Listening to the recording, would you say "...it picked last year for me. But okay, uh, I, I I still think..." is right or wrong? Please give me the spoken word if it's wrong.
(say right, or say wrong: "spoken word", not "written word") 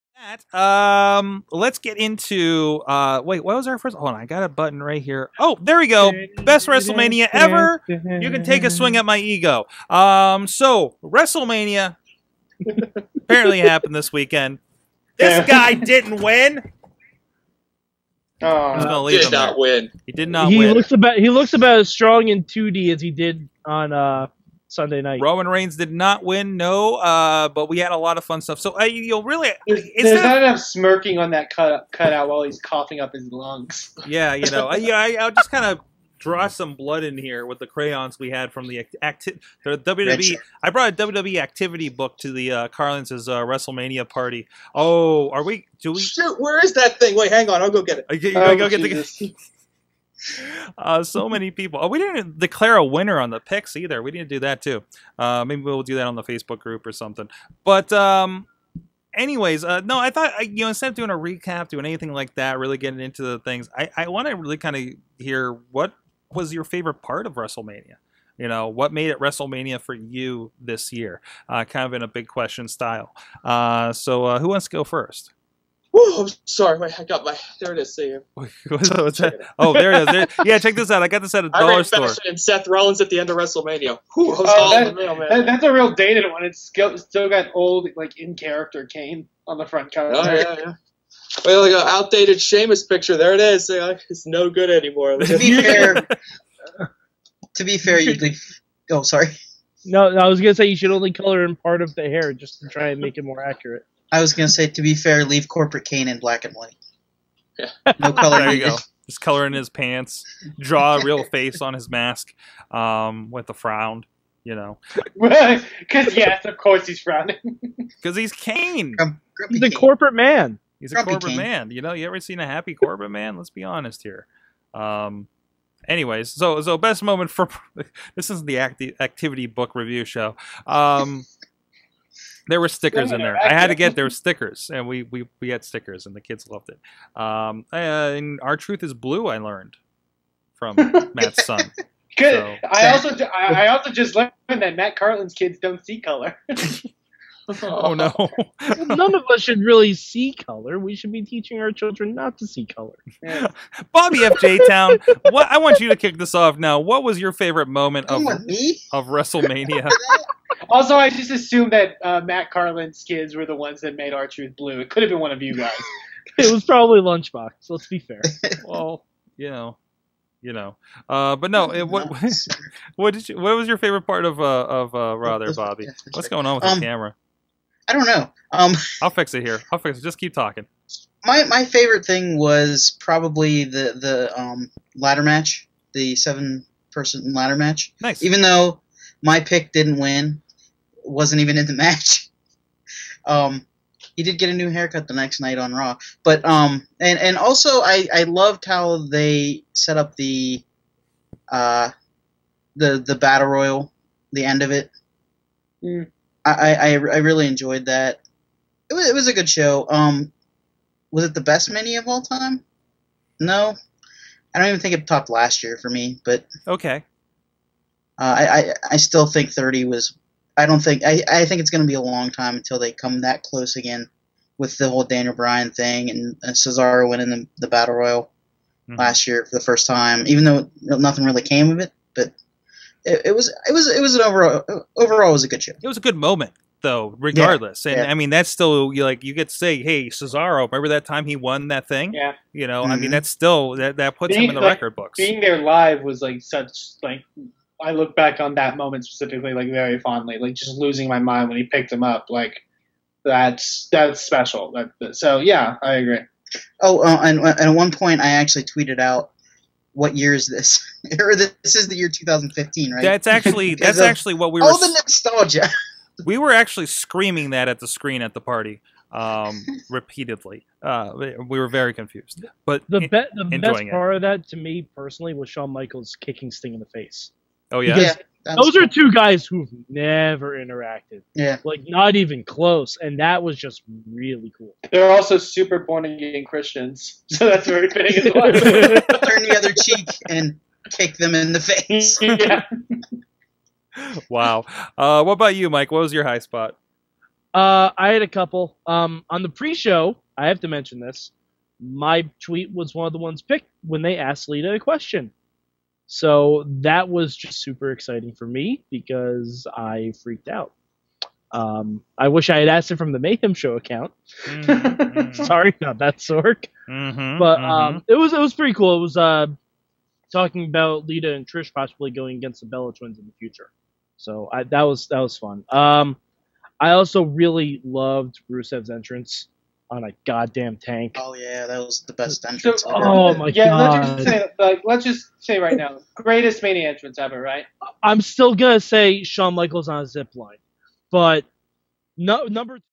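wrong: "topped", not "picked".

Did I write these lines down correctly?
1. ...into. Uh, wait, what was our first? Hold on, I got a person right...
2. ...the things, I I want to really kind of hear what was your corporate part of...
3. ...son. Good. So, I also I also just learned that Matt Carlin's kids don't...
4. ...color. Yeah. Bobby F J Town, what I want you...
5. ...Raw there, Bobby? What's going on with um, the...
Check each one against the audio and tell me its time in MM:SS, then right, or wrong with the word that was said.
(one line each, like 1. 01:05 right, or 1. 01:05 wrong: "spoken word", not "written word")
1. 00:01 wrong: "button", not "person"
2. 01:03 wrong: "favorite", not "corporate"
3. 02:21 right
4. 02:32 right
5. 02:55 right.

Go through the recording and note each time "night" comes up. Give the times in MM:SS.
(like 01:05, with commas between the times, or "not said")
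00:25, 03:15.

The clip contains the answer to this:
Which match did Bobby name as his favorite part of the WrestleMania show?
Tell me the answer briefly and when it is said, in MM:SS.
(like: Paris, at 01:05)
seven person ladder match, at 03:06.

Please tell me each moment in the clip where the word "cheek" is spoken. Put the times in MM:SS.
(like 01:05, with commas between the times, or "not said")
04:49.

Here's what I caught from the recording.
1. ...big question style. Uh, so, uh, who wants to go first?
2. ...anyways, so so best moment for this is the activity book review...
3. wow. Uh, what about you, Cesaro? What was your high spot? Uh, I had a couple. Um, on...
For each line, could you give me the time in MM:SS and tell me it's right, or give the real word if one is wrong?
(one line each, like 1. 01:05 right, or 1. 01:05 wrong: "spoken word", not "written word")
1. 01:12 right
2. 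02:05 right
3. 04:54 wrong: "Mike", not "Cesaro".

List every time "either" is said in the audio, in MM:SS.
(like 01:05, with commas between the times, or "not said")
00:53.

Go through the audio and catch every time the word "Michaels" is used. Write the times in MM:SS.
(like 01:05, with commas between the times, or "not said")
04:35, 05:39.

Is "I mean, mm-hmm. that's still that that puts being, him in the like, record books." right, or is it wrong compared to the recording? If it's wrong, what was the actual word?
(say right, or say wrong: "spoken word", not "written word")
right.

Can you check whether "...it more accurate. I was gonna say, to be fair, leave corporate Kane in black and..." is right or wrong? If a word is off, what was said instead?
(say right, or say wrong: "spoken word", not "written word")
right.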